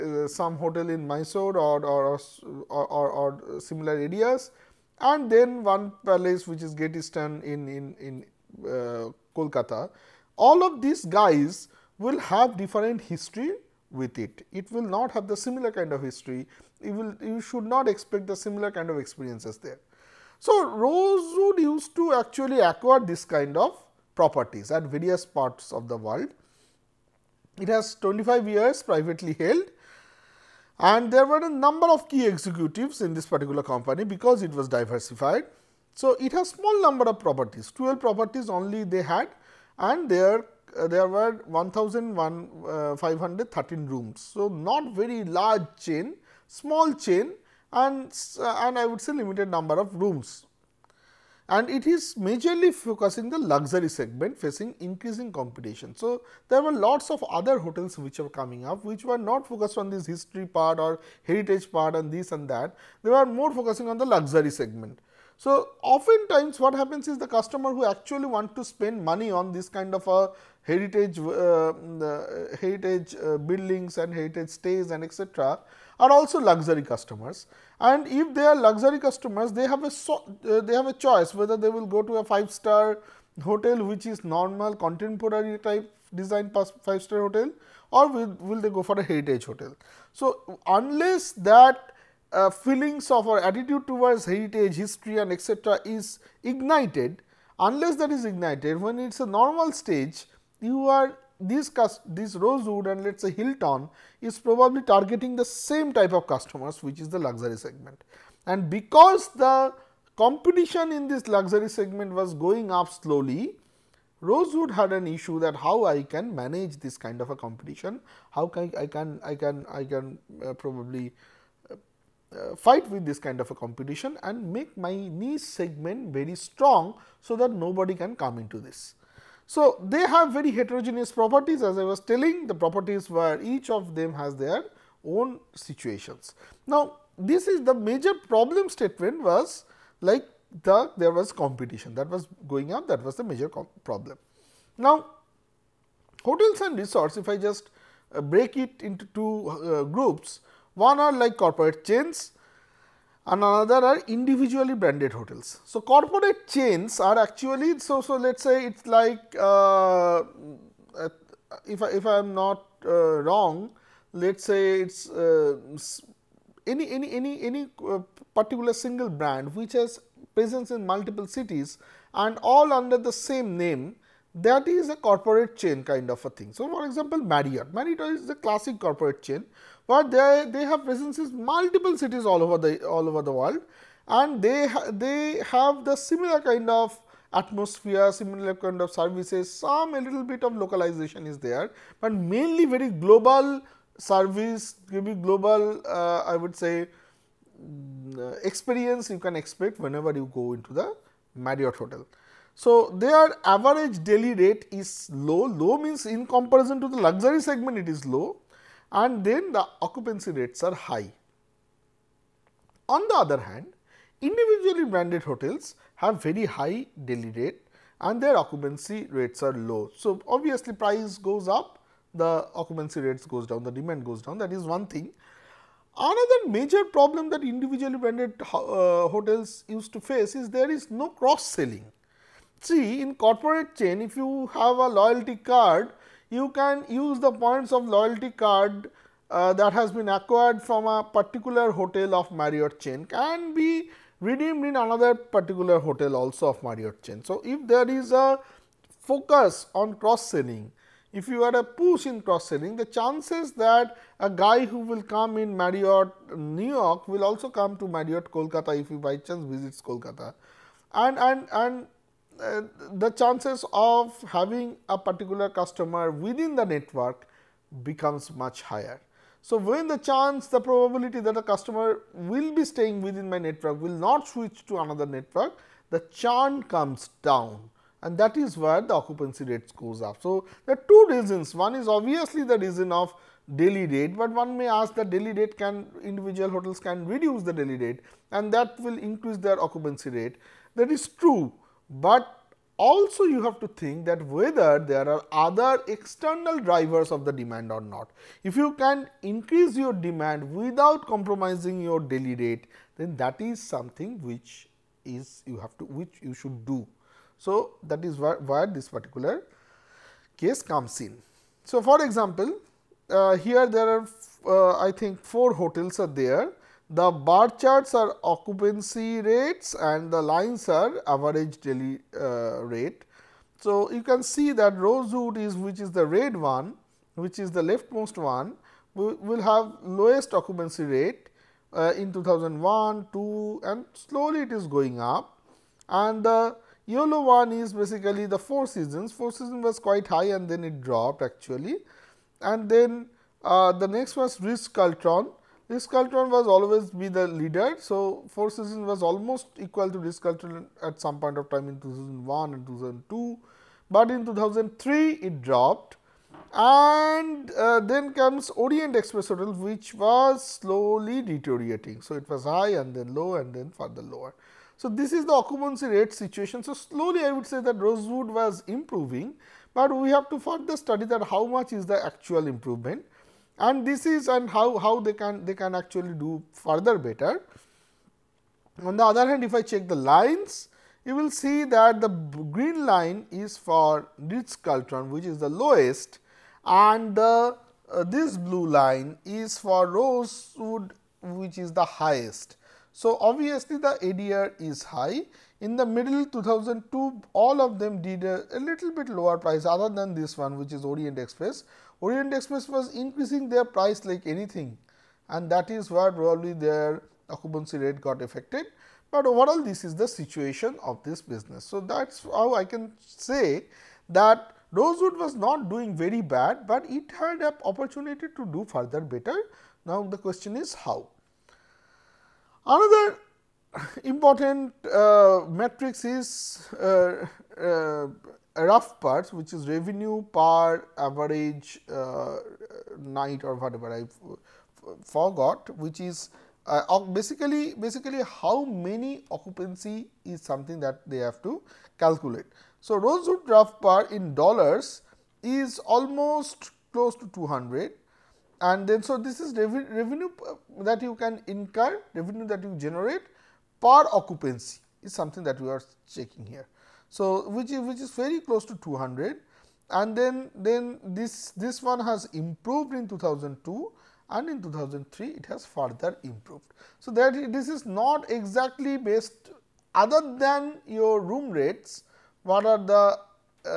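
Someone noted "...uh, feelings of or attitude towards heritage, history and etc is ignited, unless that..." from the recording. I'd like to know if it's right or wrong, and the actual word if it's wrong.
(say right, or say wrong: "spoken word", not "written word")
right.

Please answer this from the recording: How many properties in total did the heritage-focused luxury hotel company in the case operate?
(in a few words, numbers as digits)
12.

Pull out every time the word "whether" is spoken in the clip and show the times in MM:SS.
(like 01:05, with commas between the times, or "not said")
01:21, 04:54.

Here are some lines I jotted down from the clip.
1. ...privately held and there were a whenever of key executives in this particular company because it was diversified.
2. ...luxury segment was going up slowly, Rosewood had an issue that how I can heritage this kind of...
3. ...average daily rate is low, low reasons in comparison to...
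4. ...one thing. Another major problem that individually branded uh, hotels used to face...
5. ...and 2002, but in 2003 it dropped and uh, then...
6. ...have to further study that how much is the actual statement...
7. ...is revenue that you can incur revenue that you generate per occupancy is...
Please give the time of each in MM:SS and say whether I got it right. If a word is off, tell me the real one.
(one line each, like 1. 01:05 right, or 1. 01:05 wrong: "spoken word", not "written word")
1. 00:28 wrong: "number", not "whenever"
2. 01:51 wrong: "manage", not "heritage"
3. 03:23 wrong: "means", not "reasons"
4. 03:44 right
5. 05:52 right
6. 06:10 wrong: "improvement", not "statement"
7. 07:29 right.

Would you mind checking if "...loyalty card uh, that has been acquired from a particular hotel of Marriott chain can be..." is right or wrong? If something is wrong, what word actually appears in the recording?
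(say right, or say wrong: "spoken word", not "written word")
right.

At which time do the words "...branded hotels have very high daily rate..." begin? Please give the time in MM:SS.
03:34.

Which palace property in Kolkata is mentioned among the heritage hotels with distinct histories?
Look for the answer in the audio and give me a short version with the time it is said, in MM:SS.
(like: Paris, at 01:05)
Great Eastern, at 00:06.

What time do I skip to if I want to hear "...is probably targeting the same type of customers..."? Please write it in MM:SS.
01:44.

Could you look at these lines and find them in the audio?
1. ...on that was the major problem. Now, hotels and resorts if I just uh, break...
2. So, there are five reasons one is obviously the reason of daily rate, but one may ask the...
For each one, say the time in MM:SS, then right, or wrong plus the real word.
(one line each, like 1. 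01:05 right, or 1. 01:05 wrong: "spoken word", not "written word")
1. 02:22 right
2. 04:40 wrong: "two", not "five".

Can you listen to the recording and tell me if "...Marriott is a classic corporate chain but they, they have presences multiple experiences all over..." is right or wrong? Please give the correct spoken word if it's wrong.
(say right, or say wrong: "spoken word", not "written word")
wrong: "cities", not "experiences".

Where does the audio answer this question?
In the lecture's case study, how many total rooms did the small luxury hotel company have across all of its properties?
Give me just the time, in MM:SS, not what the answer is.
00:41.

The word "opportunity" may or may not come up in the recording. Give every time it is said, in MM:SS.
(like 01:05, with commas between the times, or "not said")
06:57.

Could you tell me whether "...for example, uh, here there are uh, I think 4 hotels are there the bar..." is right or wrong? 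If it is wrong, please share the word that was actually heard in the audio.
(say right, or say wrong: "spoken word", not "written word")
right.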